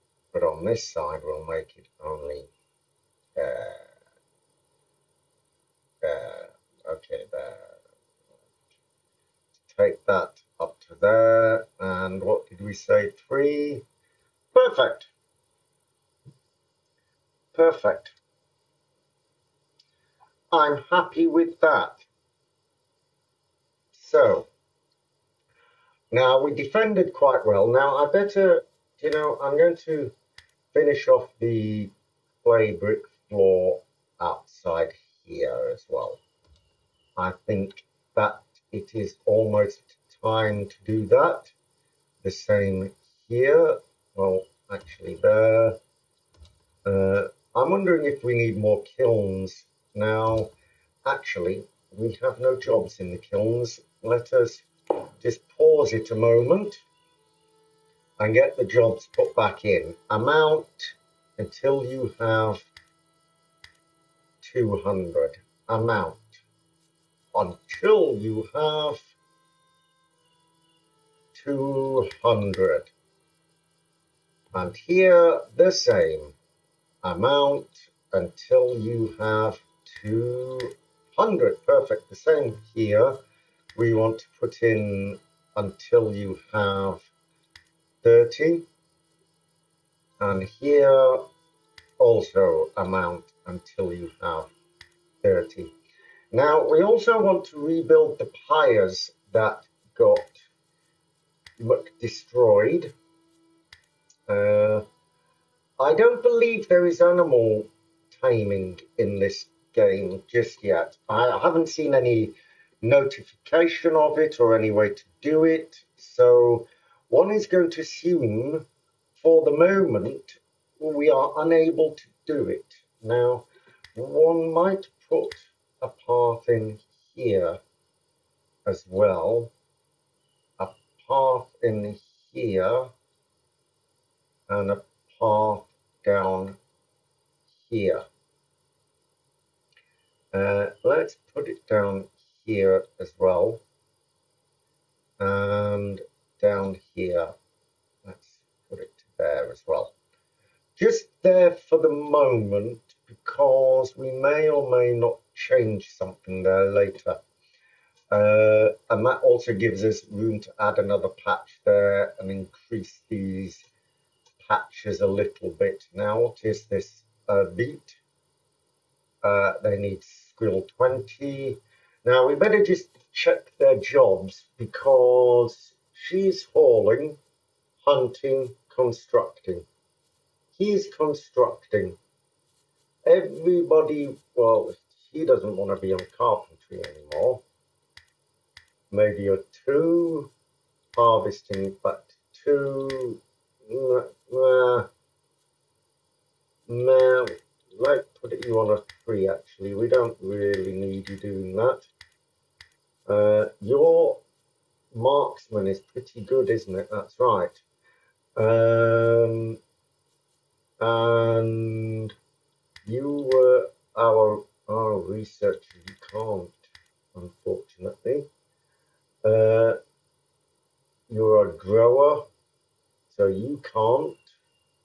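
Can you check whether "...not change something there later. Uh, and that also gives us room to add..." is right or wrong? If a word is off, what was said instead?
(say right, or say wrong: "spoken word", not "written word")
right.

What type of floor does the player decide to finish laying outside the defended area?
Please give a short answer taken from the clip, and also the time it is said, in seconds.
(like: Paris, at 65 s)
clay brick floor, at 32 s.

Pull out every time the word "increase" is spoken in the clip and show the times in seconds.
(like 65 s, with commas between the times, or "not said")
162 s.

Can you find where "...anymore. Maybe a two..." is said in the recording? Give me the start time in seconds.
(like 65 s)
186 s.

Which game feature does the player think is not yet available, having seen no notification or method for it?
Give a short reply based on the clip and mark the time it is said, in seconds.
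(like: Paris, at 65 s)
animal taming, at 107 s.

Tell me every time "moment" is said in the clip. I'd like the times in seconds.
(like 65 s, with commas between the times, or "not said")
56 s, 119 s, 151 s.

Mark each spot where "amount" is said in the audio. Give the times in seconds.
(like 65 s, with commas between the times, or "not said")
60 s, 65 s, 77 s, 92 s.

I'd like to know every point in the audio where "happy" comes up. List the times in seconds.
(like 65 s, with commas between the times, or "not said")
20 s.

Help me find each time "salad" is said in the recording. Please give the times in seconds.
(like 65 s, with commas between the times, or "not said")
not said.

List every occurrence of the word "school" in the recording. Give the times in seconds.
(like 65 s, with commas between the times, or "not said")
170 s.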